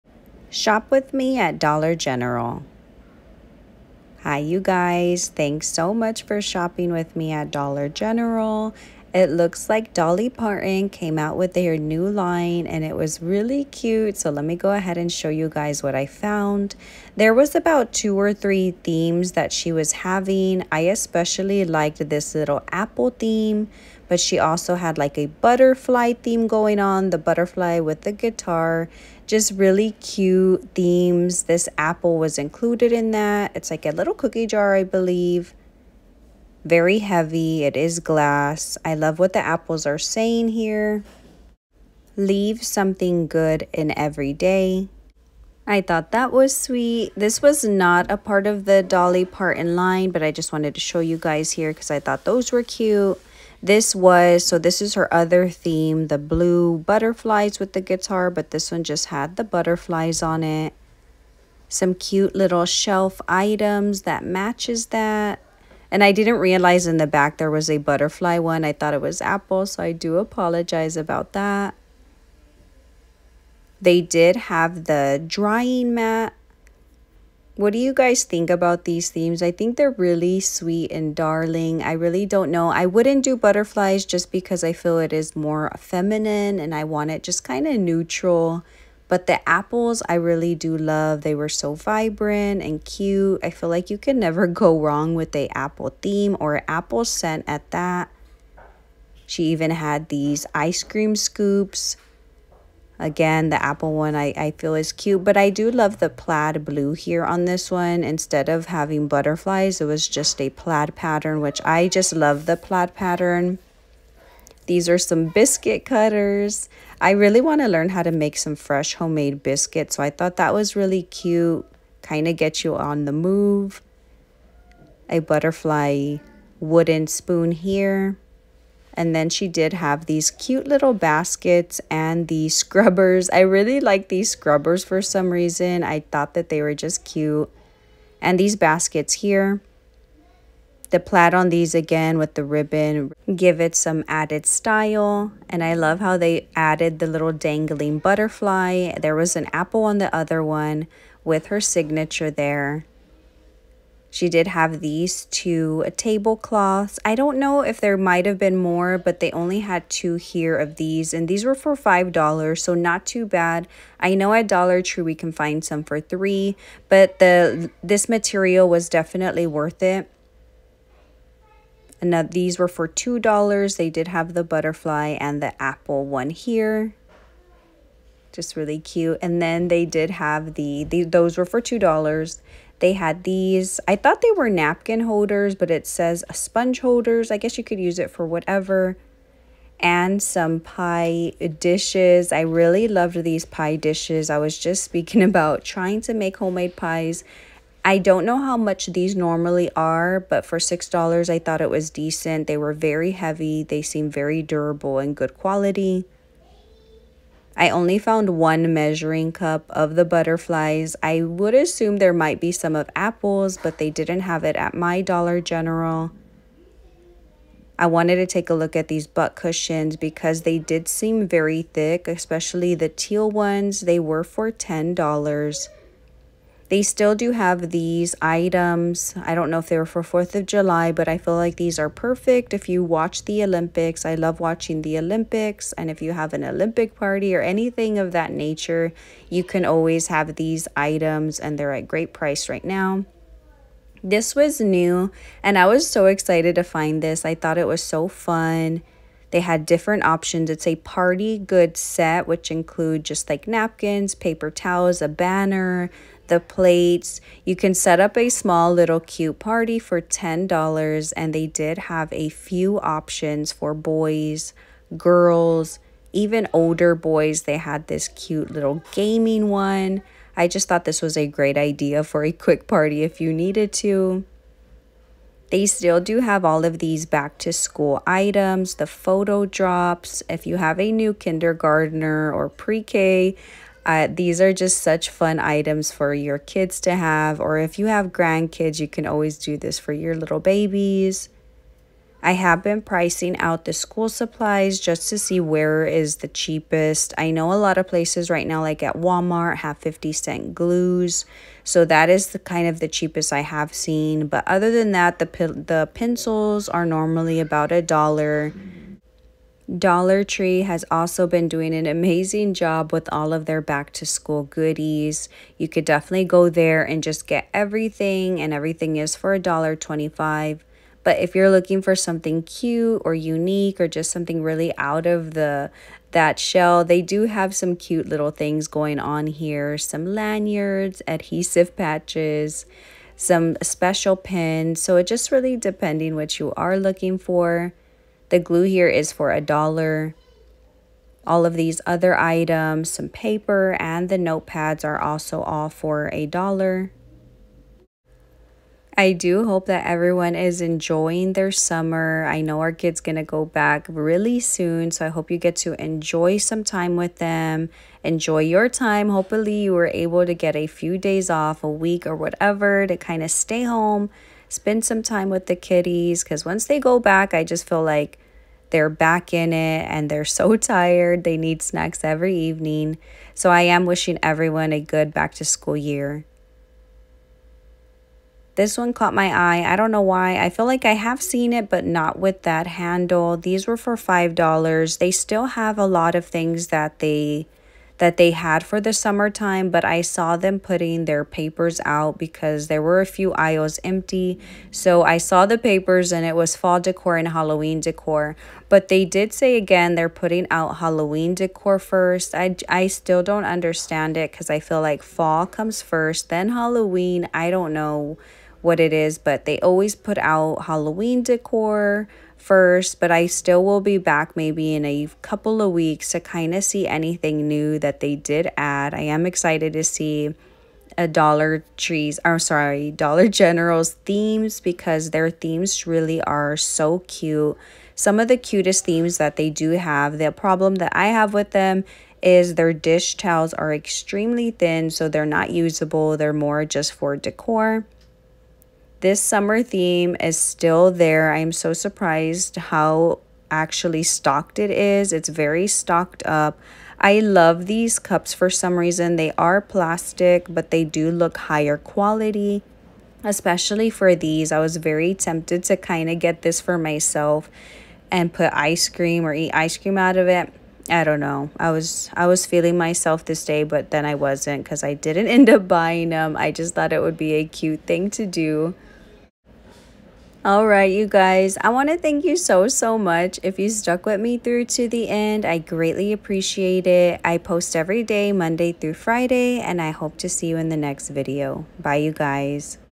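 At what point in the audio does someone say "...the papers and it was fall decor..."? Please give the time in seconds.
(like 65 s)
395 s.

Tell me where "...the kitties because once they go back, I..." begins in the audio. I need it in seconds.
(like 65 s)
365 s.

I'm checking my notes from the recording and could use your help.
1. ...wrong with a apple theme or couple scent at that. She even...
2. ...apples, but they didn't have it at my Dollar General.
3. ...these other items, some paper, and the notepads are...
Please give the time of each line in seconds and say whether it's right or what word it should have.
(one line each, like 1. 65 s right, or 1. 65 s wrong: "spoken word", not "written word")
1. 94 s wrong: "apple", not "couple"
2. 212 s right
3. 341 s right.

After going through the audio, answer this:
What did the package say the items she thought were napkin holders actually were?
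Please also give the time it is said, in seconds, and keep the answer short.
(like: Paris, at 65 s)
sponge holders, at 186 s.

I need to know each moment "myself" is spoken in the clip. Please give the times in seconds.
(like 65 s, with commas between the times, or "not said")
456 s, 462 s.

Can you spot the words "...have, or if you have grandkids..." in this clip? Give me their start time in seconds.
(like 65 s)
286 s.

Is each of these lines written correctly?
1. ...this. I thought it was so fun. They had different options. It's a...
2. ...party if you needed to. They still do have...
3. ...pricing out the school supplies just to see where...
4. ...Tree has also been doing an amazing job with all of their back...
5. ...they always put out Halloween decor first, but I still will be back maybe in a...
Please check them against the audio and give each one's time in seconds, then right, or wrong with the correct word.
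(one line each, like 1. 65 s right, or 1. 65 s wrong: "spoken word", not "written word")
1. 247 s right
2. 272 s right
3. 292 s right
4. 310 s right
5. 409 s right.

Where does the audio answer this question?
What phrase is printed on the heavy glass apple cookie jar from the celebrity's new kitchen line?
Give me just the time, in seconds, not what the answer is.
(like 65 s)
42 s.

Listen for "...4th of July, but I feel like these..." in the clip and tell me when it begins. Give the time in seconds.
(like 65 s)
230 s.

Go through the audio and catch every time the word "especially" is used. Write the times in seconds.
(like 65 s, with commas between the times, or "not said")
20 s, 222 s, 453 s.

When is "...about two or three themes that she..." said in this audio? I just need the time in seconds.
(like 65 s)
17 s.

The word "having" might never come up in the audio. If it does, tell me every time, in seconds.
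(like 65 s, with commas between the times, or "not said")
19 s, 108 s.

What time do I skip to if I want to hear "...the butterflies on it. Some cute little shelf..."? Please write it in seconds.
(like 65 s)
59 s.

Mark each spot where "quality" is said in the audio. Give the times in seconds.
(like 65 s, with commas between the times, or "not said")
205 s, 451 s.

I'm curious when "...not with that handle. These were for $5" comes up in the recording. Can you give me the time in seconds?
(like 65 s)
381 s.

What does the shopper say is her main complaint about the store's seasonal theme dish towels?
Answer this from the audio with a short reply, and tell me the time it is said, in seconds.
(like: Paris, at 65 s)
extremely thin, at 433 s.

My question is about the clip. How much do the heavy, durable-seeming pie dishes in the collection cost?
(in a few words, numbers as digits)
$6.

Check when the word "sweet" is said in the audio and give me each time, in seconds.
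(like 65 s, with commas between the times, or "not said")
46 s, 80 s.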